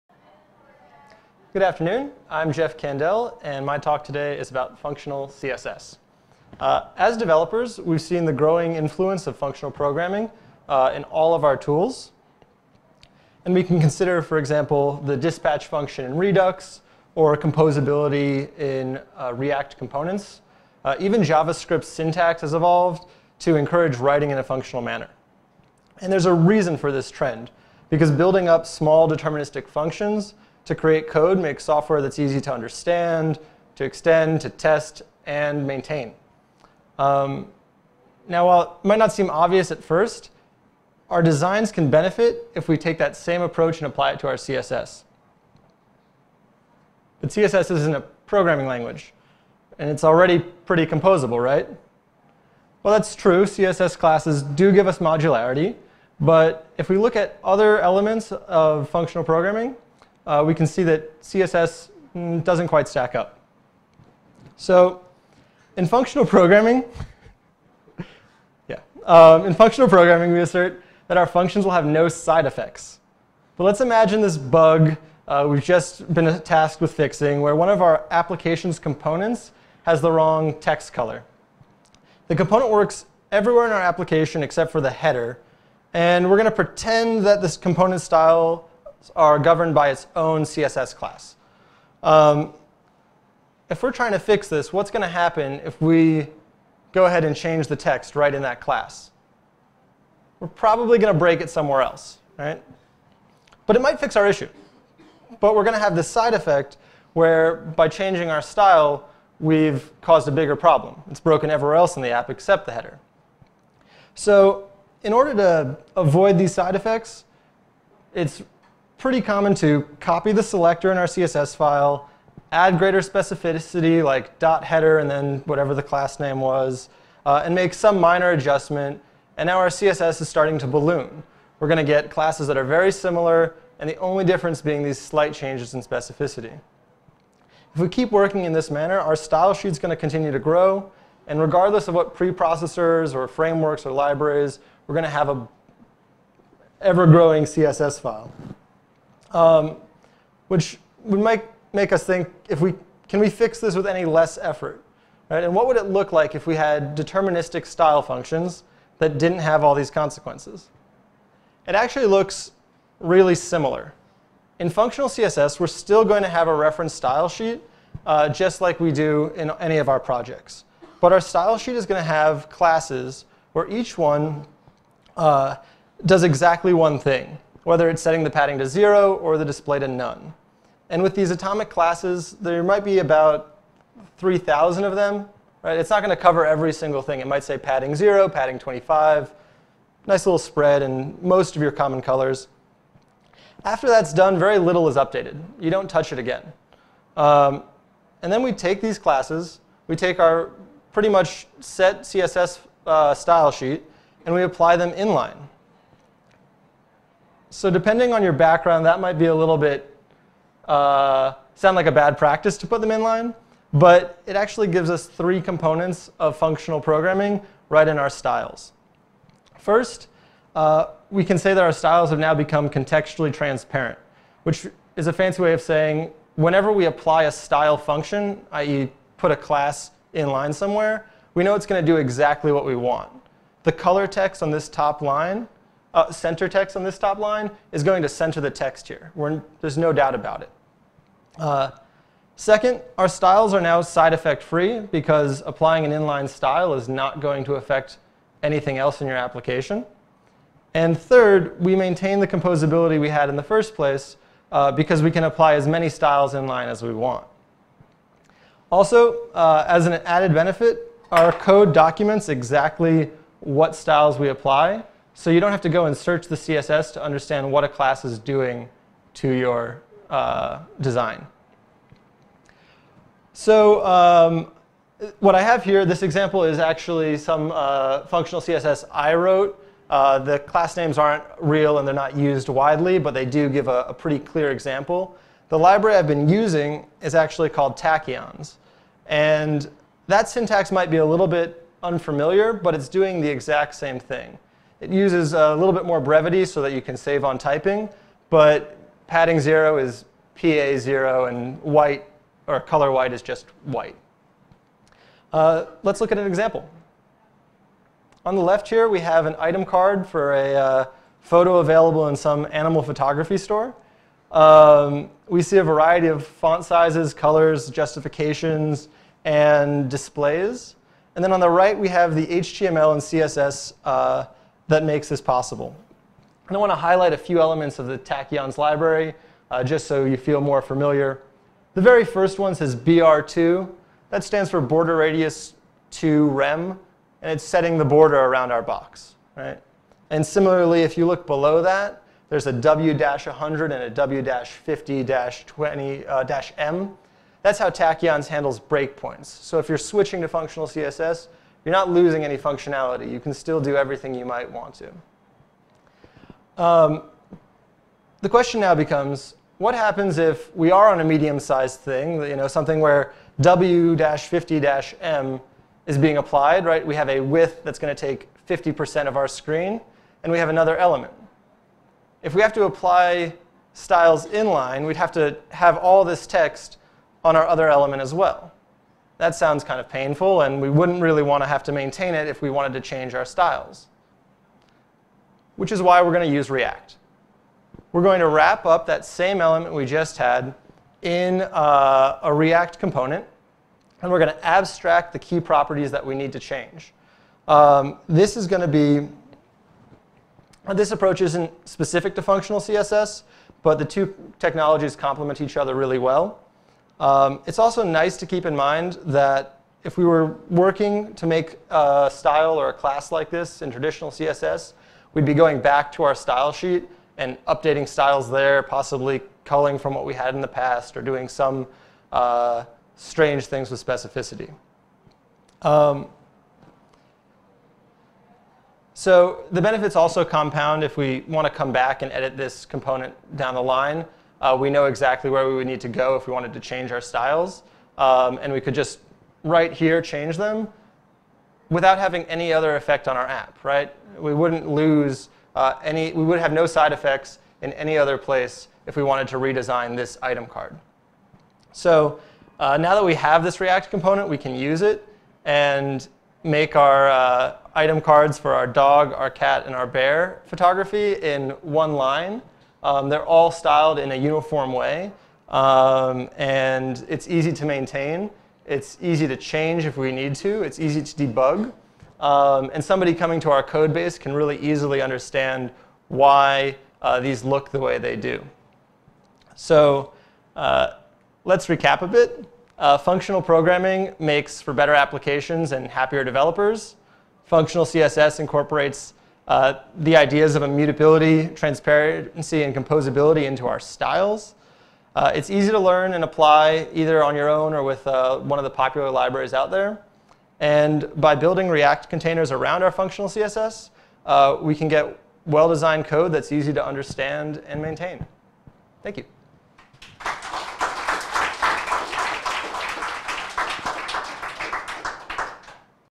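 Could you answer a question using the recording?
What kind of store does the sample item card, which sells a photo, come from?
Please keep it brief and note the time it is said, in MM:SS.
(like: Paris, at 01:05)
animal photography store, at 05:12.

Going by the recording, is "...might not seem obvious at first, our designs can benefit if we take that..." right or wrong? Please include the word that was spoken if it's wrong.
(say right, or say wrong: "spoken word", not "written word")
right.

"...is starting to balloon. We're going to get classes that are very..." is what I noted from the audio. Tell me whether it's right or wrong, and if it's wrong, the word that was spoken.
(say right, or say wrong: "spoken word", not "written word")
right.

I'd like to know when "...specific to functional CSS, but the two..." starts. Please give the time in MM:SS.
06:41.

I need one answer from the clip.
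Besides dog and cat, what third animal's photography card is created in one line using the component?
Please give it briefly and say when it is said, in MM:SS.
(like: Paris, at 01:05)
bear, at 07:39.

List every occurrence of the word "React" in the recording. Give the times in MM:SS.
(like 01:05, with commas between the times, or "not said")
00:19, 06:26, 06:32, 07:33, 08:21.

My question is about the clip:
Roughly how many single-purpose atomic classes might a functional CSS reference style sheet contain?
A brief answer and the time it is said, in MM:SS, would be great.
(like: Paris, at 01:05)
3,000, at 03:04.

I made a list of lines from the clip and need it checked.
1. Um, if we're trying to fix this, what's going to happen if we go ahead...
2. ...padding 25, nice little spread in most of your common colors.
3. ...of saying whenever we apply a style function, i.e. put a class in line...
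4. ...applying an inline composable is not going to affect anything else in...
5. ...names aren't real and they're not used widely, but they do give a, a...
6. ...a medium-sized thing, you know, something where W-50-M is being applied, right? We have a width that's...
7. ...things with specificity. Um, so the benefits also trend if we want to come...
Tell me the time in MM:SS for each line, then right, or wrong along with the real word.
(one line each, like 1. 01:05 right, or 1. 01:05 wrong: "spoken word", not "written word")
1. 01:32 right
2. 03:08 right
3. 03:45 right
4. 04:05 wrong: "style", not "composable"
5. 04:40 right
6. 06:00 right
7. 07:03 wrong: "compound", not "trend".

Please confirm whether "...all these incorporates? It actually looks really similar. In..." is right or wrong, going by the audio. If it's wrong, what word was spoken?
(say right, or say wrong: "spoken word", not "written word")
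wrong: "consequences", not "incorporates".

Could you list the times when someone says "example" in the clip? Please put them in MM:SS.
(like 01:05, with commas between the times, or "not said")
00:14, 04:36, 04:44, 05:06.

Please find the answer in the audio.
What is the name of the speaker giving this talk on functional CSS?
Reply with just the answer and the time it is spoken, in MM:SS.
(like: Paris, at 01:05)
Jeff Candel, at 00:02.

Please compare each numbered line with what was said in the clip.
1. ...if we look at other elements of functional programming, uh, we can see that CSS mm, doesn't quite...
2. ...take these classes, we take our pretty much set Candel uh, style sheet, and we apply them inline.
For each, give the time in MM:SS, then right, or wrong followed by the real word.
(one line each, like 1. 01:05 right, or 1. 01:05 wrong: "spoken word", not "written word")
1. 00:56 right
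2. 03:18 wrong: "CSS", not "Candel".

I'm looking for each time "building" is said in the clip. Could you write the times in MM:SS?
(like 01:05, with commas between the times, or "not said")
00:28, 08:21.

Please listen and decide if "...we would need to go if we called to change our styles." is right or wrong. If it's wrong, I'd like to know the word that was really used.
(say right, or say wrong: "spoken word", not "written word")
wrong: "wanted", not "called".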